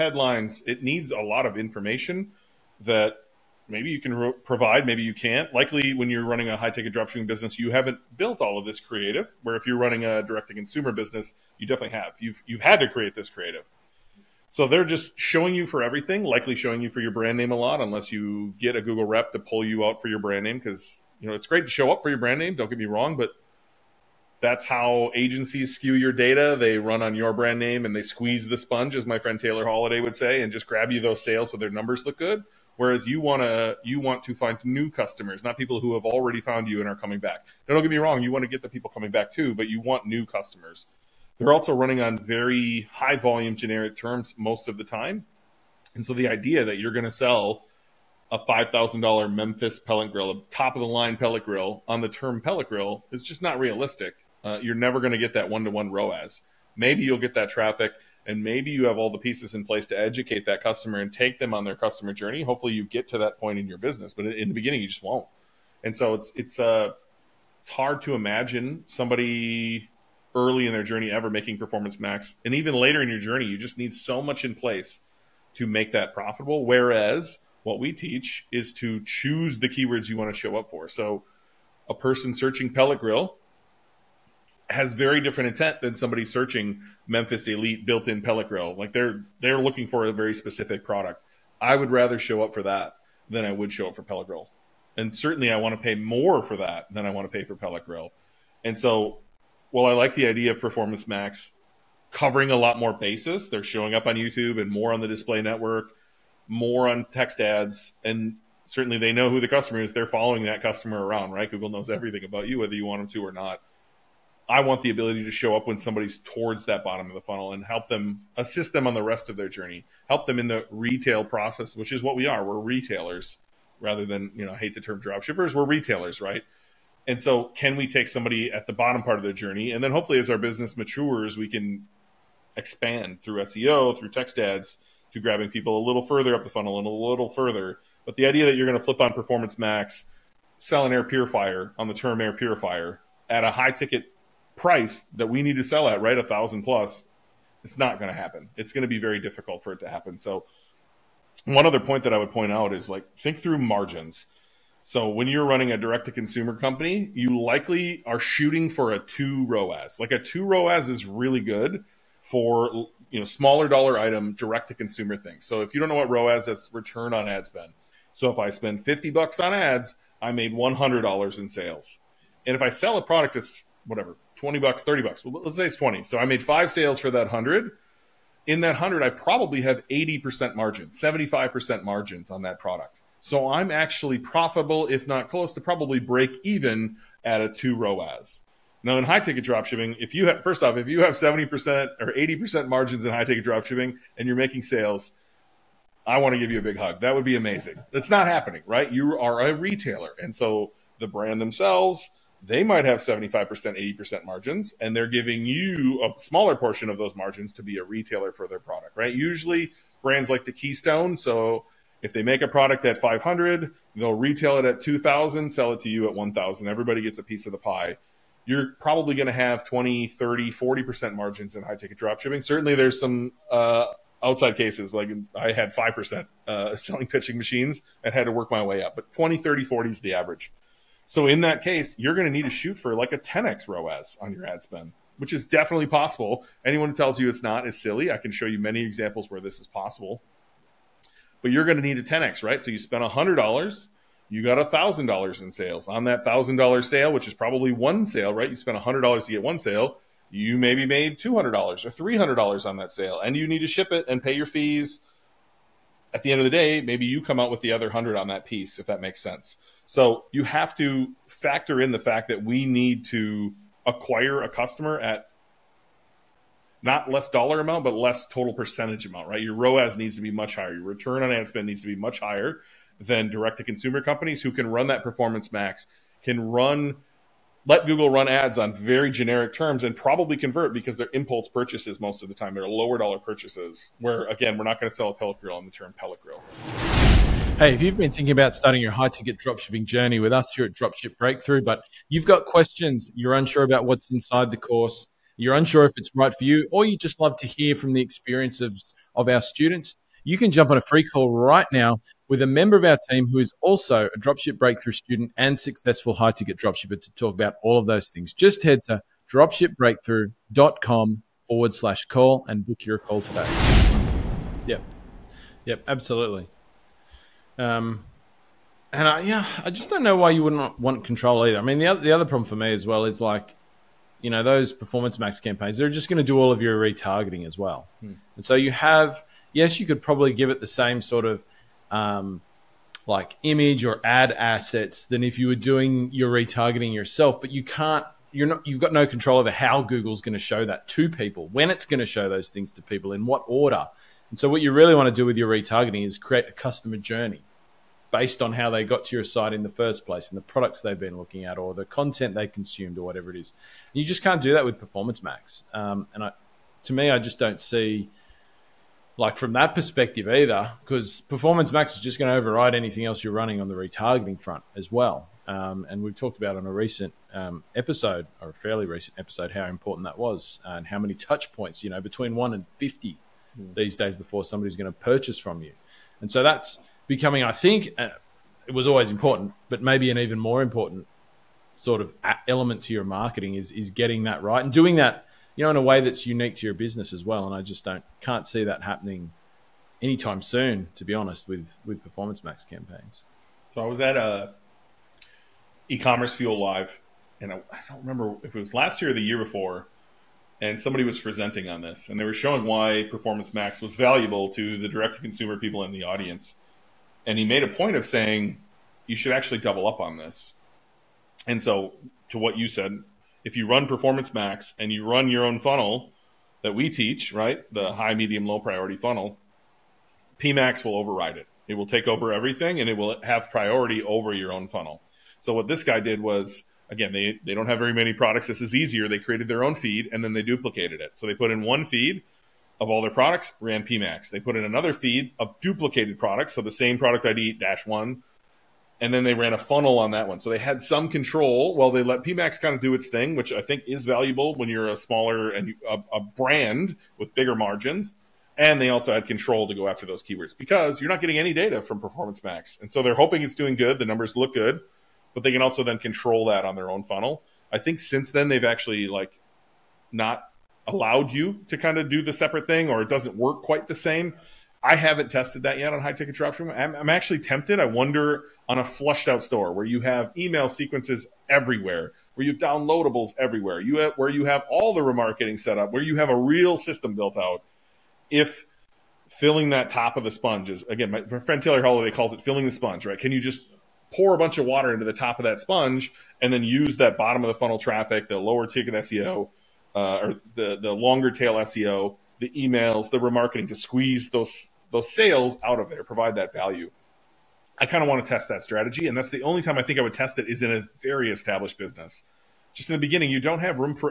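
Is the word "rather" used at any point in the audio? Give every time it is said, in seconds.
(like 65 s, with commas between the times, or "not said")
91 s, 123 s.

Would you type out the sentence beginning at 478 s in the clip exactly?
If filling that top of the sponge is again, my friend Taylor Holiday calls it filling the sponge, right?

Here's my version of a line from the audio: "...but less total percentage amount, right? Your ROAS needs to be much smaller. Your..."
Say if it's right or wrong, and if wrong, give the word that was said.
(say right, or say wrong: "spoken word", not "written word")
wrong: "higher", not "smaller".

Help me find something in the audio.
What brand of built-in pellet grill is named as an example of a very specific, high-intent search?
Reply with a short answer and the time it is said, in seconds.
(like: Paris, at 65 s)
Memphis Elite, at 87 s.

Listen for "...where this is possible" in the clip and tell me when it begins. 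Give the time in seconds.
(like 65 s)
239 s.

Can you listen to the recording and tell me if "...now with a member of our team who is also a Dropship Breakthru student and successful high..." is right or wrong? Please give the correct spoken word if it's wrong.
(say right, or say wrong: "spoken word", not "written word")
right.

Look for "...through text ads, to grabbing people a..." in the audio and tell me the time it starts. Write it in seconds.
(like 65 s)
133 s.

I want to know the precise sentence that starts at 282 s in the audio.
They're lower dollar purchases, where again, we're not going to sell a pellet grill on the term pellet grill.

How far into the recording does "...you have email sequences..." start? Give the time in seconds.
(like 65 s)
469 s.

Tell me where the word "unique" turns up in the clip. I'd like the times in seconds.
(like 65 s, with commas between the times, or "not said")
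386 s.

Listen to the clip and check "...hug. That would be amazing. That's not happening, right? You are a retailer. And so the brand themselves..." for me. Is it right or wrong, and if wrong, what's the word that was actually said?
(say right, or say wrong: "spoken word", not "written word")
right.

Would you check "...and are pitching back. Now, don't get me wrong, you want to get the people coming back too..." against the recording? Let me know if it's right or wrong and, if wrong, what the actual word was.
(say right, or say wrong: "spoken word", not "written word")
wrong: "coming", not "pitching".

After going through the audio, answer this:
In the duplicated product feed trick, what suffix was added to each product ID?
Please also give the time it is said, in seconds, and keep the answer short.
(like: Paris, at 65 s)
dash one, at 437 s.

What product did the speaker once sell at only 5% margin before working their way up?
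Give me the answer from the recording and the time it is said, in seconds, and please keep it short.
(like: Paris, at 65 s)
pitching machines, at 227 s.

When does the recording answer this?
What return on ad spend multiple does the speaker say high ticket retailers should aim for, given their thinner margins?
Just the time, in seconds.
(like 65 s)
233 s.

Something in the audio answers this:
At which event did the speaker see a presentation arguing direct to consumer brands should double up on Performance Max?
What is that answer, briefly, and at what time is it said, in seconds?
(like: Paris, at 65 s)
eCommerceFuel Live, at 395 s.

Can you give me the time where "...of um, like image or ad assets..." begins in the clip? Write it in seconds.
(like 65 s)
331 s.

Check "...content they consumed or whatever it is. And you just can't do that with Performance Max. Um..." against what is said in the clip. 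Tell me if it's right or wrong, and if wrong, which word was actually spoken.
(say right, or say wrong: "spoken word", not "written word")
right.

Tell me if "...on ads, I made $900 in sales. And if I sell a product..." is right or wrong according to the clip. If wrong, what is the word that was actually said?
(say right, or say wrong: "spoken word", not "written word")
wrong: "100", not "900".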